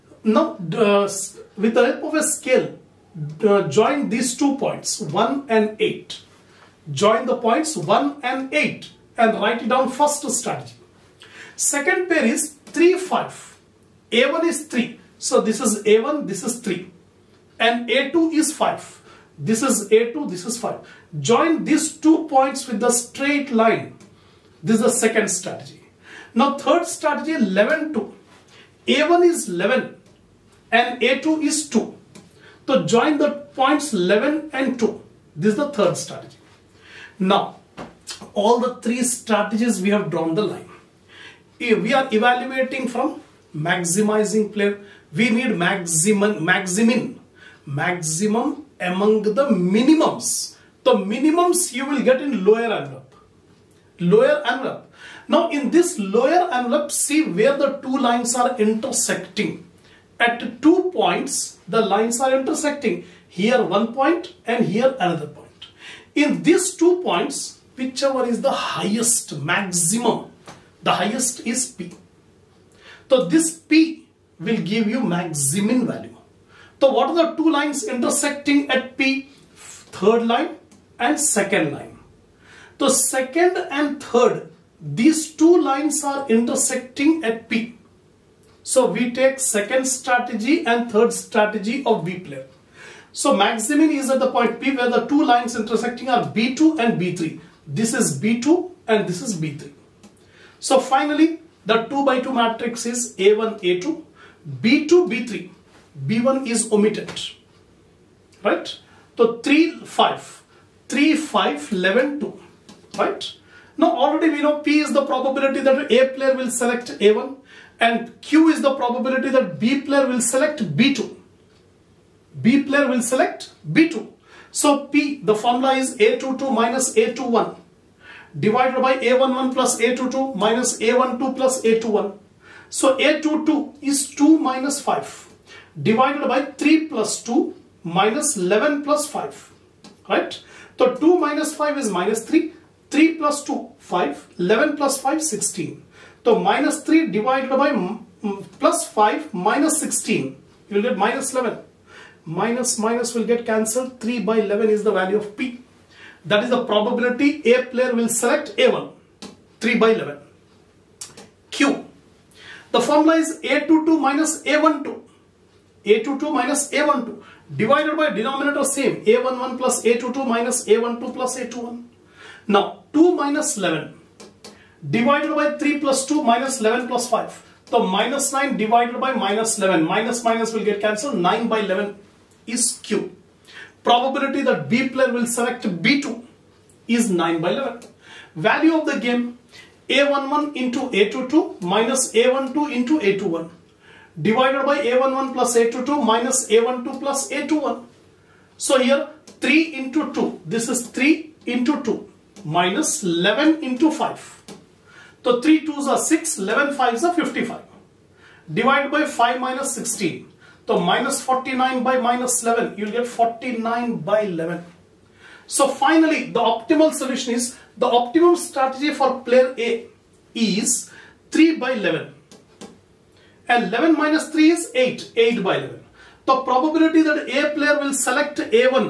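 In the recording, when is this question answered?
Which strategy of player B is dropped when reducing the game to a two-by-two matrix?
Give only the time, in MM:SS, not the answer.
01:46.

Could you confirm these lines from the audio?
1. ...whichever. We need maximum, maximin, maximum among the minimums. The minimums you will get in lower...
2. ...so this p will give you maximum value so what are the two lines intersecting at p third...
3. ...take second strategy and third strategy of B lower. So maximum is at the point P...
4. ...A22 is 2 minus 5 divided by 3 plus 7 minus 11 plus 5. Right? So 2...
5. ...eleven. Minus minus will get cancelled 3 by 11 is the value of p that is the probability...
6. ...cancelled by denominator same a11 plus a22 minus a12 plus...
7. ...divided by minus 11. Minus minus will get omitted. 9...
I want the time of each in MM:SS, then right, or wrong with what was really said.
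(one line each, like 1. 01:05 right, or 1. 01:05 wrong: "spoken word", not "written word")
1. 00:44 wrong: "player", not "whichever"
2. 01:13 right
3. 01:29 wrong: "player", not "lower"
4. 02:12 wrong: "2", not "7"
5. 02:31 right
6. 02:47 wrong: "divided", not "cancelled"
7. 02:58 wrong: "cancelled", not "omitted".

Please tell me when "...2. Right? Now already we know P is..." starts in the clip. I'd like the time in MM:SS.
01:52.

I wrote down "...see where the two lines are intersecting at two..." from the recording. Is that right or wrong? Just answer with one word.
right.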